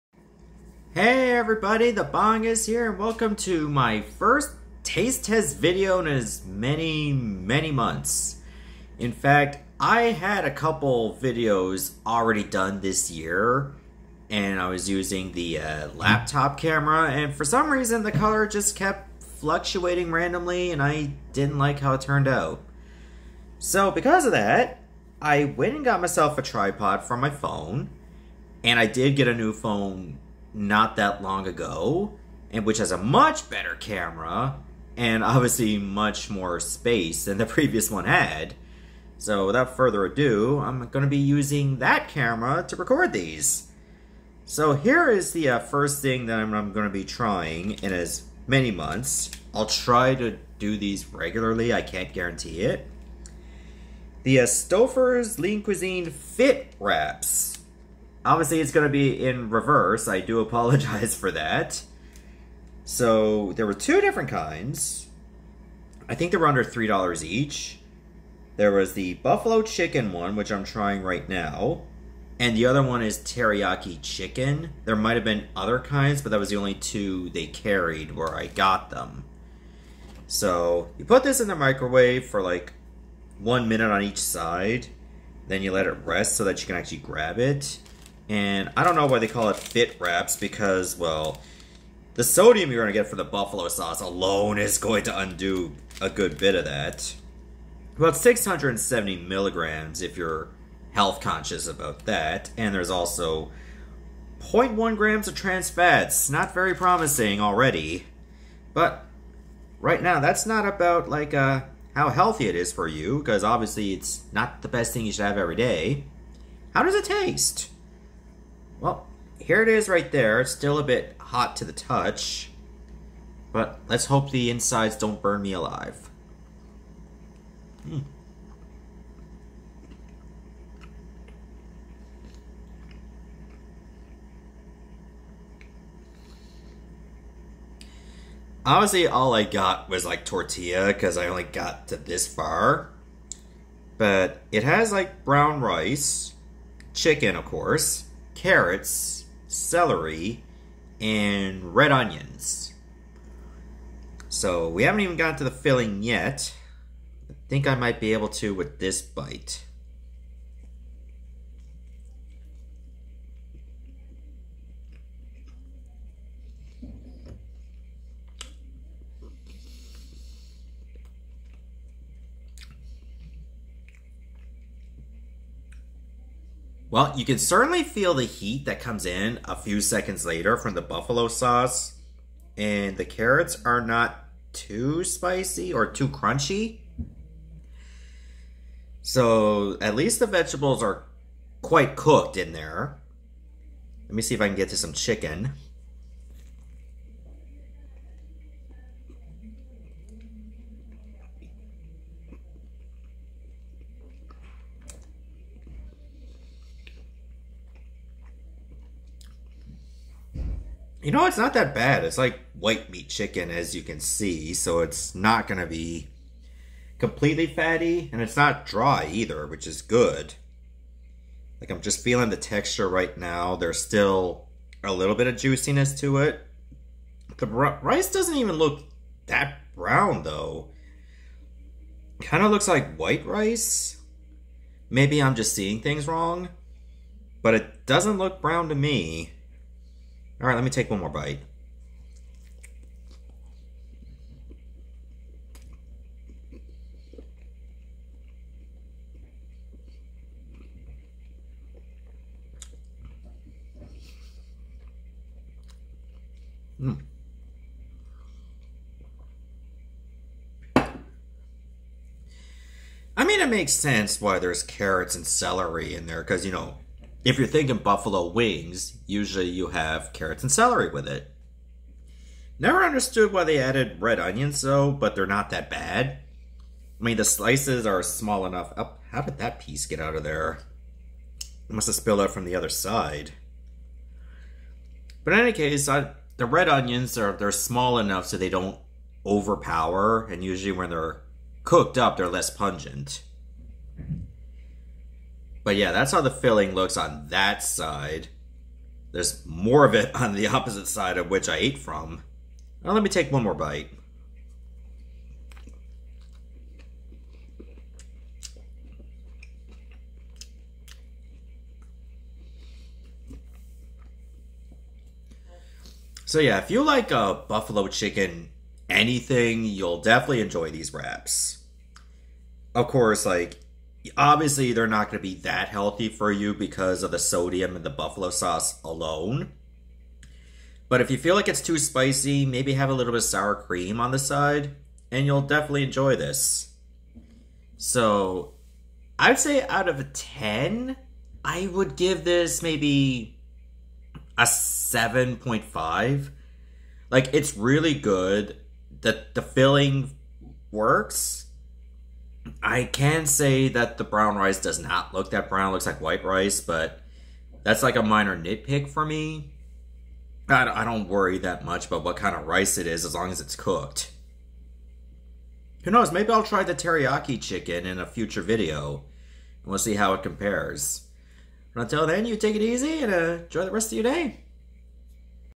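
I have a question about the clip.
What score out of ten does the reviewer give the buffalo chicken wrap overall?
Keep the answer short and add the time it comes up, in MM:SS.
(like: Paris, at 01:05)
7.5, at 05:44.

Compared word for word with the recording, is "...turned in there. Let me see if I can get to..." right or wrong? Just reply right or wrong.
wrong.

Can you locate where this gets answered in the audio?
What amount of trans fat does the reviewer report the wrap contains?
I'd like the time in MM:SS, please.
01:44.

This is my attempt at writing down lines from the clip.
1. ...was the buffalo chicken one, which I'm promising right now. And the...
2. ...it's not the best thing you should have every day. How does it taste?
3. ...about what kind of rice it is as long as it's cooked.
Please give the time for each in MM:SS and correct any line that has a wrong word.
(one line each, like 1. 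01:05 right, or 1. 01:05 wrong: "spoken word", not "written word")
1. 01:08 wrong: "trying", not "promising"
2. 01:53 right
3. 06:01 right.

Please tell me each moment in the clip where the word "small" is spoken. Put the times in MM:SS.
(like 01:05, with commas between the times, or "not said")
04:38, 04:47.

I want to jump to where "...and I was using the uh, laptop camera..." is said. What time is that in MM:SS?
00:14.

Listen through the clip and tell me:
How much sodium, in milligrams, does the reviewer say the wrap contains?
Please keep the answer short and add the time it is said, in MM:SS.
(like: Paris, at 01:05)
670 milligrams, at 01:37.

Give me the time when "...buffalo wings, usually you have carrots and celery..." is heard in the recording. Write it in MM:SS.
04:27.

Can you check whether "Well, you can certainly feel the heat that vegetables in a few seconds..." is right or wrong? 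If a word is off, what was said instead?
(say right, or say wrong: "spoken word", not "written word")
wrong: "comes", not "vegetables".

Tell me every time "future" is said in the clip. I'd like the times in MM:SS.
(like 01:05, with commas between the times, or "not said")
06:08.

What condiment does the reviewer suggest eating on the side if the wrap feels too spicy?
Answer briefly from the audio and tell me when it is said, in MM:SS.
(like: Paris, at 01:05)
sour cream, at 05:33.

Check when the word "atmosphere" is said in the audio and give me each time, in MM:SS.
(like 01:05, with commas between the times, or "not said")
not said.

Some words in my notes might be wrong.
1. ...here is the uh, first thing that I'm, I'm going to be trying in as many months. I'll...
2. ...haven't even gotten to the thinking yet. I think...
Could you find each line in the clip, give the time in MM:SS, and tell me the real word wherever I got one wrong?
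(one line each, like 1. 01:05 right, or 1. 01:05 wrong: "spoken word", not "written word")
1. 00:44 right
2. 02:34 wrong: "filling", not "thinking".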